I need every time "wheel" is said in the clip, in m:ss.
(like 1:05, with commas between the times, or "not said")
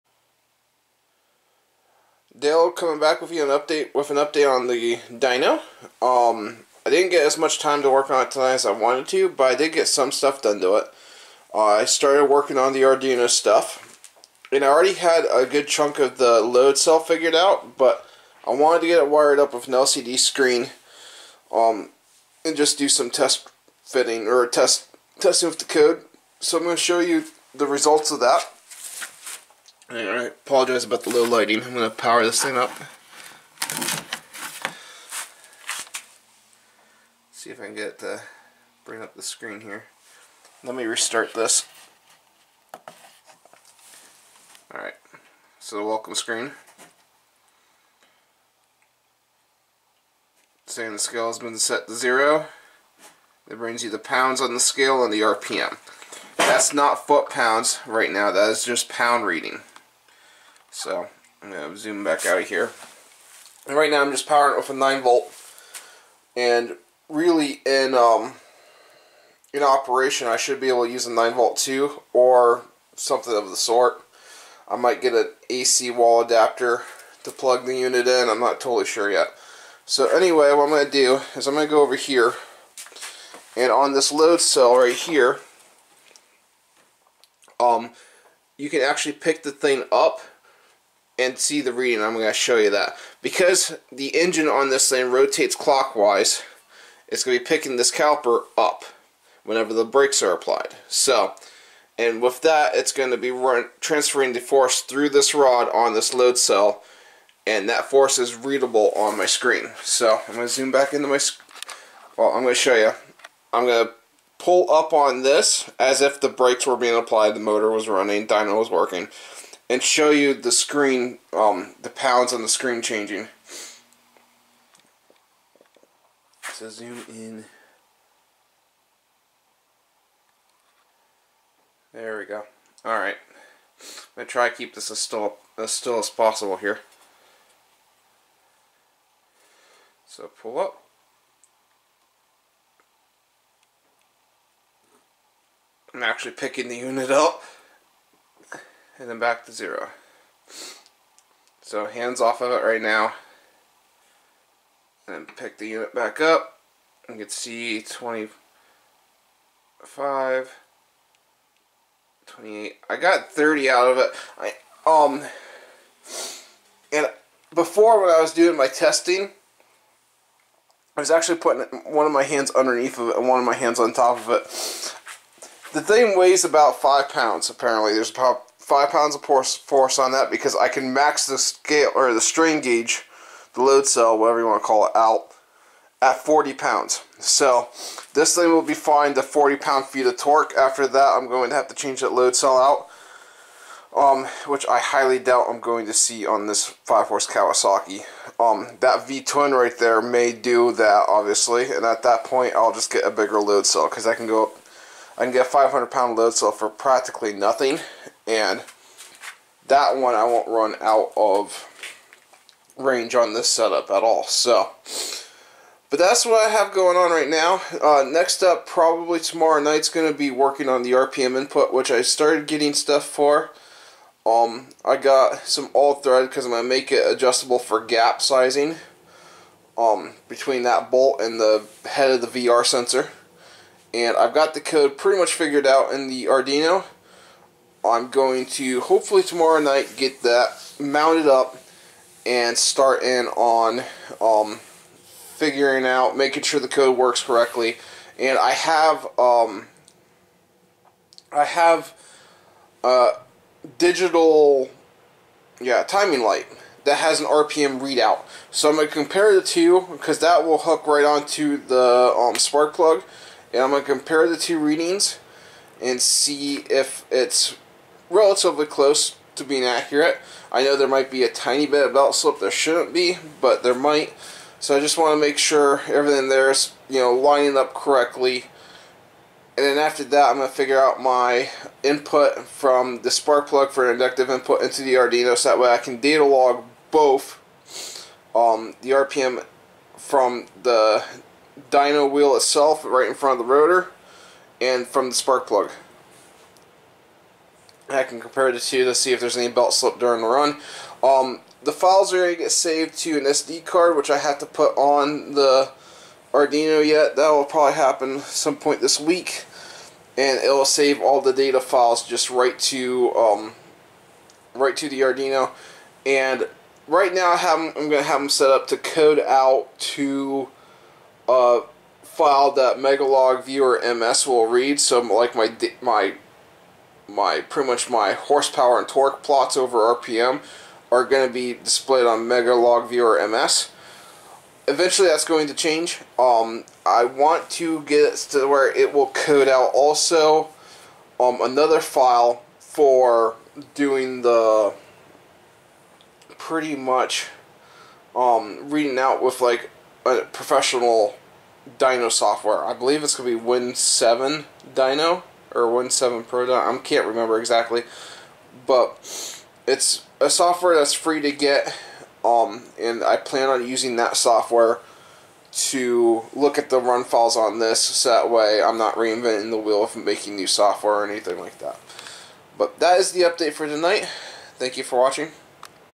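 4:52, 6:09.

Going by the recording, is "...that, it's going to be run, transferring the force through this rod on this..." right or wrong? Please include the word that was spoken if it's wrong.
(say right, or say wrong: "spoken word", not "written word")
right.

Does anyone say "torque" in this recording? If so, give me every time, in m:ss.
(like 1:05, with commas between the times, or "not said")
3:10, 5:28.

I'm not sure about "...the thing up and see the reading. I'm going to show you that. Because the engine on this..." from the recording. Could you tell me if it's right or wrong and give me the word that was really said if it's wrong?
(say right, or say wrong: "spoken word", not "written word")
right.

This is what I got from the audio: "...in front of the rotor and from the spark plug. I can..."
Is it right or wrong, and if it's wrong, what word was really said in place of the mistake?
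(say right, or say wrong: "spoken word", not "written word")
right.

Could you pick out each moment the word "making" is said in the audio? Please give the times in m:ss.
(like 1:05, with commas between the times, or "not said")
4:06, 6:09.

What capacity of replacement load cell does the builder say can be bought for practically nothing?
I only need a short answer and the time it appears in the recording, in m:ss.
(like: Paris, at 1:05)
500 pound, at 3:25.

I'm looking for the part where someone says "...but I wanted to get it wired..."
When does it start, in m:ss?
0:17.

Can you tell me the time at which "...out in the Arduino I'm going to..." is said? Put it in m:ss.
3:55.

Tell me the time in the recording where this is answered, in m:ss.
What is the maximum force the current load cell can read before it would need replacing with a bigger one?
3:06.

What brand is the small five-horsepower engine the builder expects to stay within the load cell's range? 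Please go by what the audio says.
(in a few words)
Kawasaki.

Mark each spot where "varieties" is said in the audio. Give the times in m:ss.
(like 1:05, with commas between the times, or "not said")
not said.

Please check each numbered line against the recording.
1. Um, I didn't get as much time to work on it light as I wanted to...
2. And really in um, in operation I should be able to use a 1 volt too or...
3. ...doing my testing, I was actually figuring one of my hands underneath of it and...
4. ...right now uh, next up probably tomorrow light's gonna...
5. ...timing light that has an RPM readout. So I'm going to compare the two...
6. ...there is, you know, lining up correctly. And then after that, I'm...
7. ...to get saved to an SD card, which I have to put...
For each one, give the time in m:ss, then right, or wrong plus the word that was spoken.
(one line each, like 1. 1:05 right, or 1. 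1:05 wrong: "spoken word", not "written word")
1. 0:06 wrong: "tonight", not "light"
2. 1:06 wrong: "9", not "1"
3. 2:48 wrong: "putting", not "figuring"
4. 3:37 wrong: "night", not "light"
5. 4:15 right
6. 4:36 right
7. 5:02 right.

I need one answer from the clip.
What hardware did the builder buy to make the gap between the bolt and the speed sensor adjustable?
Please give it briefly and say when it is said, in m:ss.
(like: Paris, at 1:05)
all thread, at 3:45.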